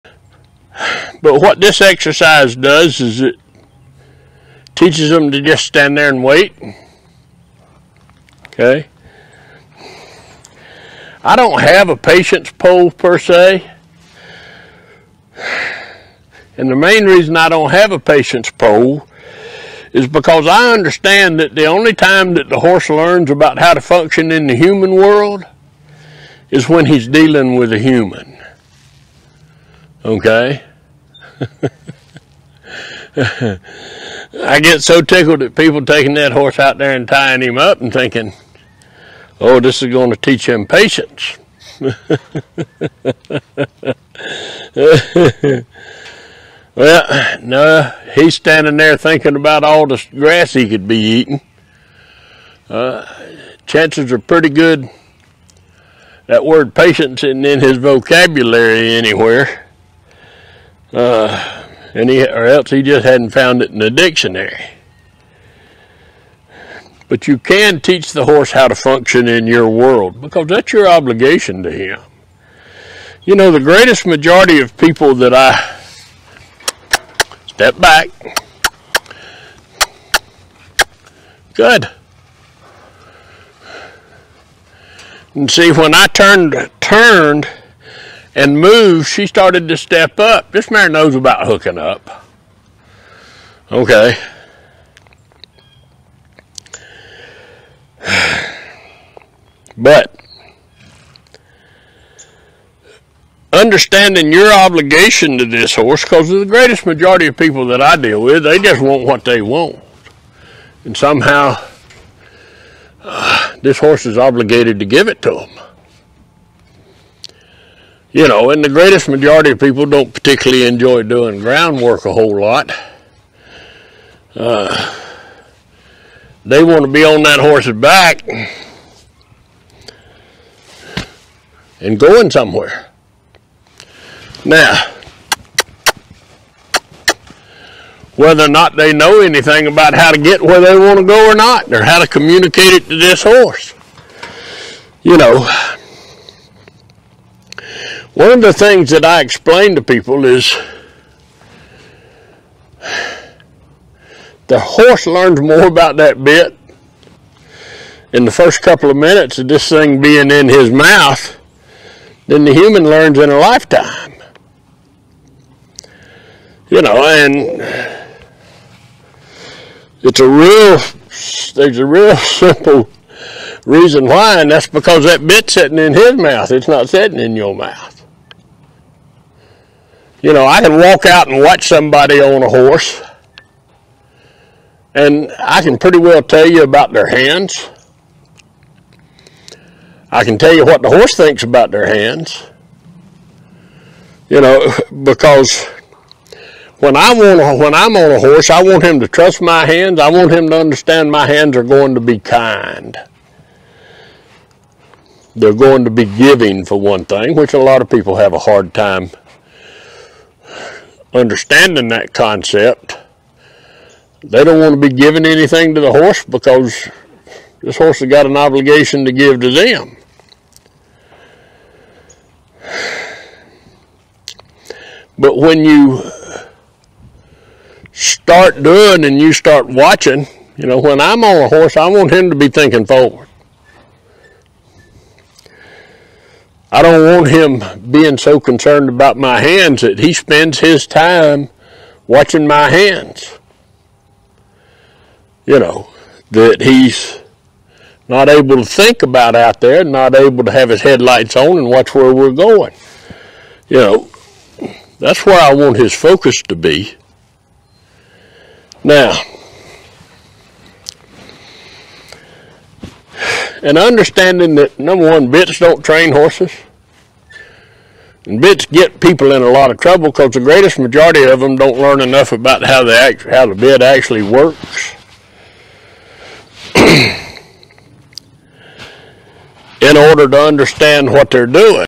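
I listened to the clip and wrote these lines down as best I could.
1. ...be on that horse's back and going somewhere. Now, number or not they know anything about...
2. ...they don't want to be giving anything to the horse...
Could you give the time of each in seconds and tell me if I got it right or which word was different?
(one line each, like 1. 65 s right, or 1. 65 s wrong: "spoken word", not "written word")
1. 126 s wrong: "whether", not "number"
2. 214 s right.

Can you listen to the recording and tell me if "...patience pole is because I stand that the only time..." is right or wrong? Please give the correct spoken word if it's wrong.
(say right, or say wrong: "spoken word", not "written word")
wrong: "understand", not "stand".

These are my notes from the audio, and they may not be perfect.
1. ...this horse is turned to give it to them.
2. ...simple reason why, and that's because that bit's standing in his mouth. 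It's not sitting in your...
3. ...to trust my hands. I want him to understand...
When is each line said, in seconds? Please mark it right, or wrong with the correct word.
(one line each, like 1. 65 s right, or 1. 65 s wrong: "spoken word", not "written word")
1. 113 s wrong: "obligated", not "turned"
2. 172 s wrong: "sitting", not "standing"
3. 198 s right.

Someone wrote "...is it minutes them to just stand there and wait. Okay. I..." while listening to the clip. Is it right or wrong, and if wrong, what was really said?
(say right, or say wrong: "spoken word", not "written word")
wrong: "teaches", not "minutes".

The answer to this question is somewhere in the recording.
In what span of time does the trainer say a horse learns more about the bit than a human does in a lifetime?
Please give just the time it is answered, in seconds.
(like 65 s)
158 s.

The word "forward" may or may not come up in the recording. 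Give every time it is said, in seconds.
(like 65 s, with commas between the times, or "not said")
232 s.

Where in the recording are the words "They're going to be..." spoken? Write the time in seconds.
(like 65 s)
205 s.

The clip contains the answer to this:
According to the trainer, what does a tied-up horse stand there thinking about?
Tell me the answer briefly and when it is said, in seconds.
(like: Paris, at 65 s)
grass, at 50 s.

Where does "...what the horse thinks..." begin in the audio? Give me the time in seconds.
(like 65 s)
190 s.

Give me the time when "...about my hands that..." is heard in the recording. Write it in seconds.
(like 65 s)
238 s.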